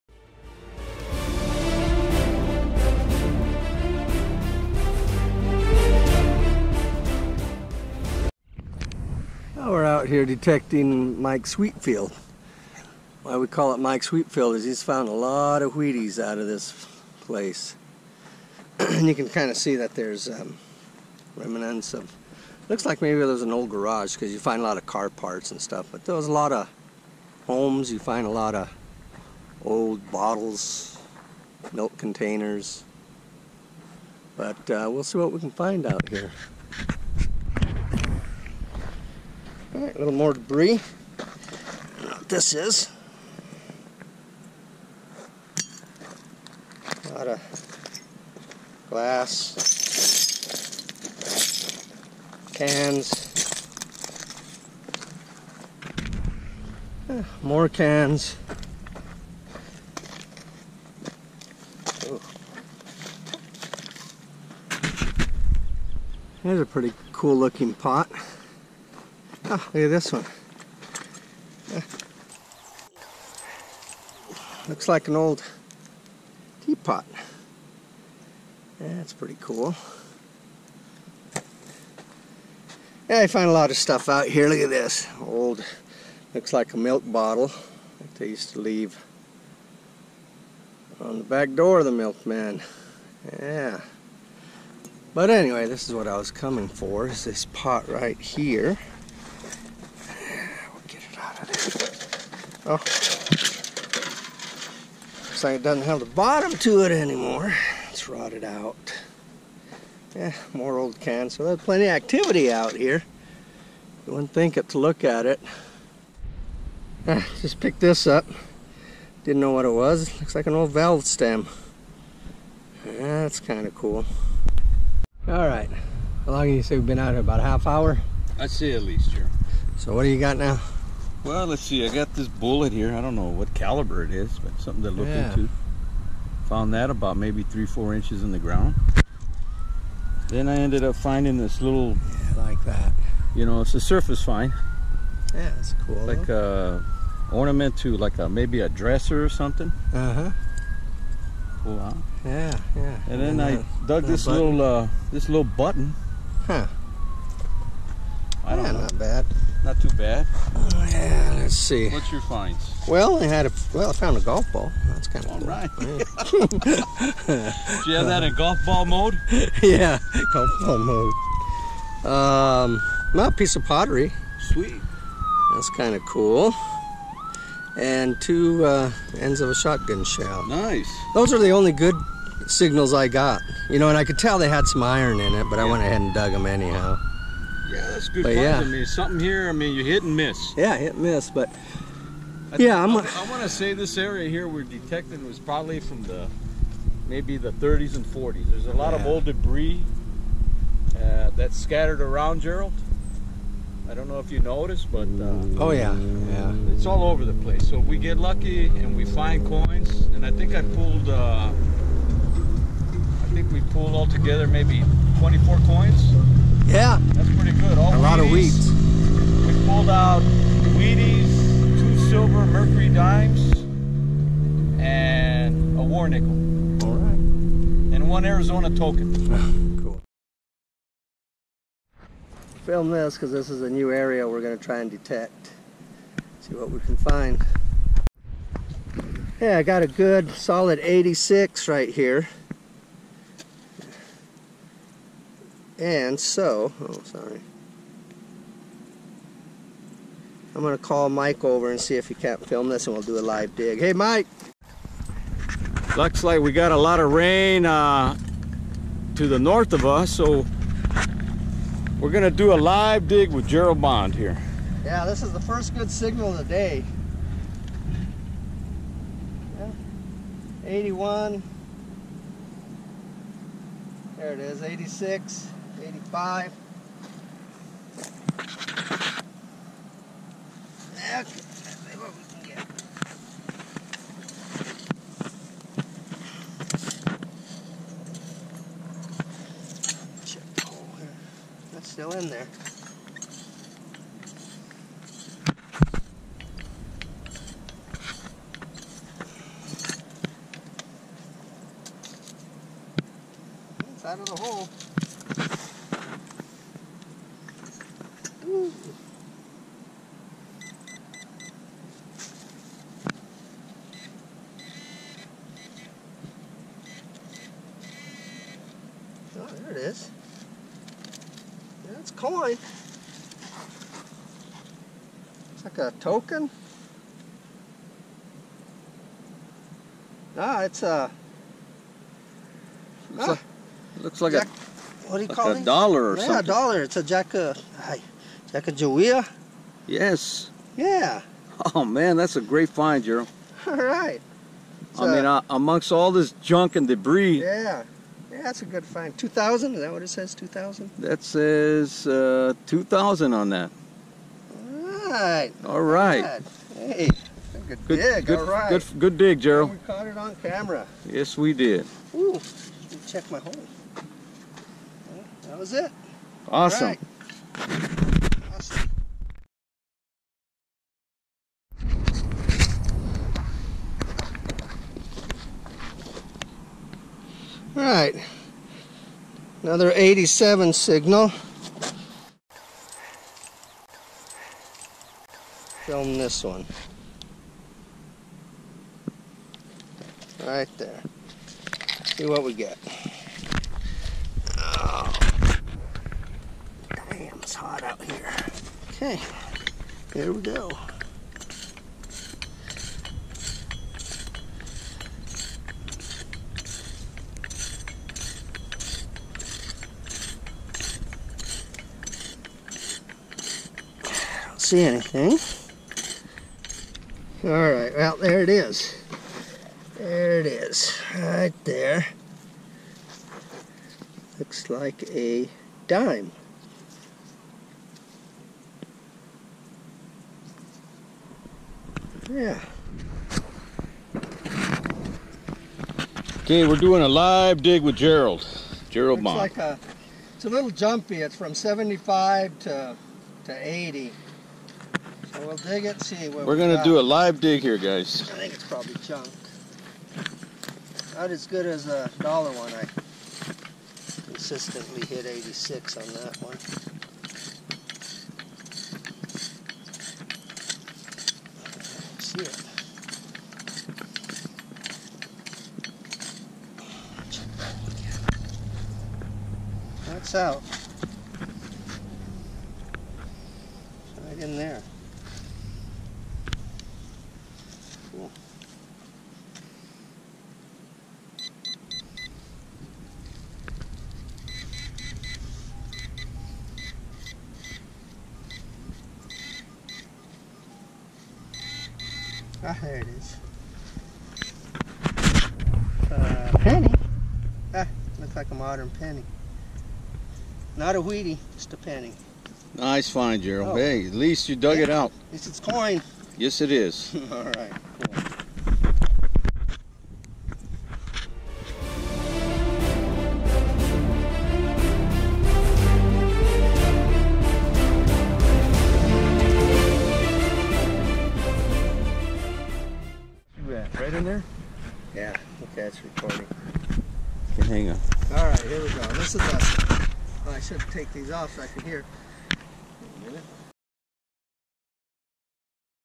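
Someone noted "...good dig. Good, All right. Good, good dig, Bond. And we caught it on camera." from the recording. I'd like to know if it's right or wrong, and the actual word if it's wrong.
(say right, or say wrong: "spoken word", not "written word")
wrong: "Gerald", not "Bond".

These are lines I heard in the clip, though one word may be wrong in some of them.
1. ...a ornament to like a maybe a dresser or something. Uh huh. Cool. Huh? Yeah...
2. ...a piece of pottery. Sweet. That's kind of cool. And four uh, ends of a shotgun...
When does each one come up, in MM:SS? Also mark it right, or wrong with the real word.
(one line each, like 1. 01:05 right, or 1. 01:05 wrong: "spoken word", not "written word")
1. 02:26 right
2. 02:53 wrong: "two", not "four".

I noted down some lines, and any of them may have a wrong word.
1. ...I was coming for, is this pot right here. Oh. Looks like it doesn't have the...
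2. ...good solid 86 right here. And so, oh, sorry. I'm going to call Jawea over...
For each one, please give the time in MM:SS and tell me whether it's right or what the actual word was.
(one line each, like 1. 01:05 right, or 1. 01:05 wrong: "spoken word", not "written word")
1. 01:36 right
2. 03:59 wrong: "Mike", not "Jawea".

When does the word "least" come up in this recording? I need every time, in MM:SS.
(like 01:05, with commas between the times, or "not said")
02:08, 08:24.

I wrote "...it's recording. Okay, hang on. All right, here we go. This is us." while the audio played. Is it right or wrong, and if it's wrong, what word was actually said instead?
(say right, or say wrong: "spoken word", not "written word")
right.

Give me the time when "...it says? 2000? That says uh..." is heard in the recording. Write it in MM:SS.
05:50.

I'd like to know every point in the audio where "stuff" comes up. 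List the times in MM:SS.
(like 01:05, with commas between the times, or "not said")
00:25, 01:23.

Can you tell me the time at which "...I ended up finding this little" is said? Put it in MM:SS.
02:20.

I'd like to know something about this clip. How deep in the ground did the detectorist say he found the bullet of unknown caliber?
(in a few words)
3 to 4 inches.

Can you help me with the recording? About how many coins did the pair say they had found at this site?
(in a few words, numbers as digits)
24.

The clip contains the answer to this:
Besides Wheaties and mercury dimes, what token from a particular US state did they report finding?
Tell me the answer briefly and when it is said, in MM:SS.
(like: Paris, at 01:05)
Arizona token, at 03:48.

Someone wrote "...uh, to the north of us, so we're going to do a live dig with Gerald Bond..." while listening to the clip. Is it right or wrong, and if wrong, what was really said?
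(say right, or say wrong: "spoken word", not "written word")
right.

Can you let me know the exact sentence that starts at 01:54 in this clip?
You wouldn't think it to look at it.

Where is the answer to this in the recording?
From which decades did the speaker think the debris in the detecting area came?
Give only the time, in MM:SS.
03:17.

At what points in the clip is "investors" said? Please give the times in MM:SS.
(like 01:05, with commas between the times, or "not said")
not said.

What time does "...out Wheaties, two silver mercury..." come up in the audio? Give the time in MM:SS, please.
03:39.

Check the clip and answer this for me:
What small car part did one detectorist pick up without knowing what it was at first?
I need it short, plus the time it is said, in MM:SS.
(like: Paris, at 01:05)
valve stem, at 02:00.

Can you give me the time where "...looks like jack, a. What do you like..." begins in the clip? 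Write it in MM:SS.
05:34.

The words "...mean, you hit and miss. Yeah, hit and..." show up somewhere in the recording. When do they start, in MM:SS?
03:09.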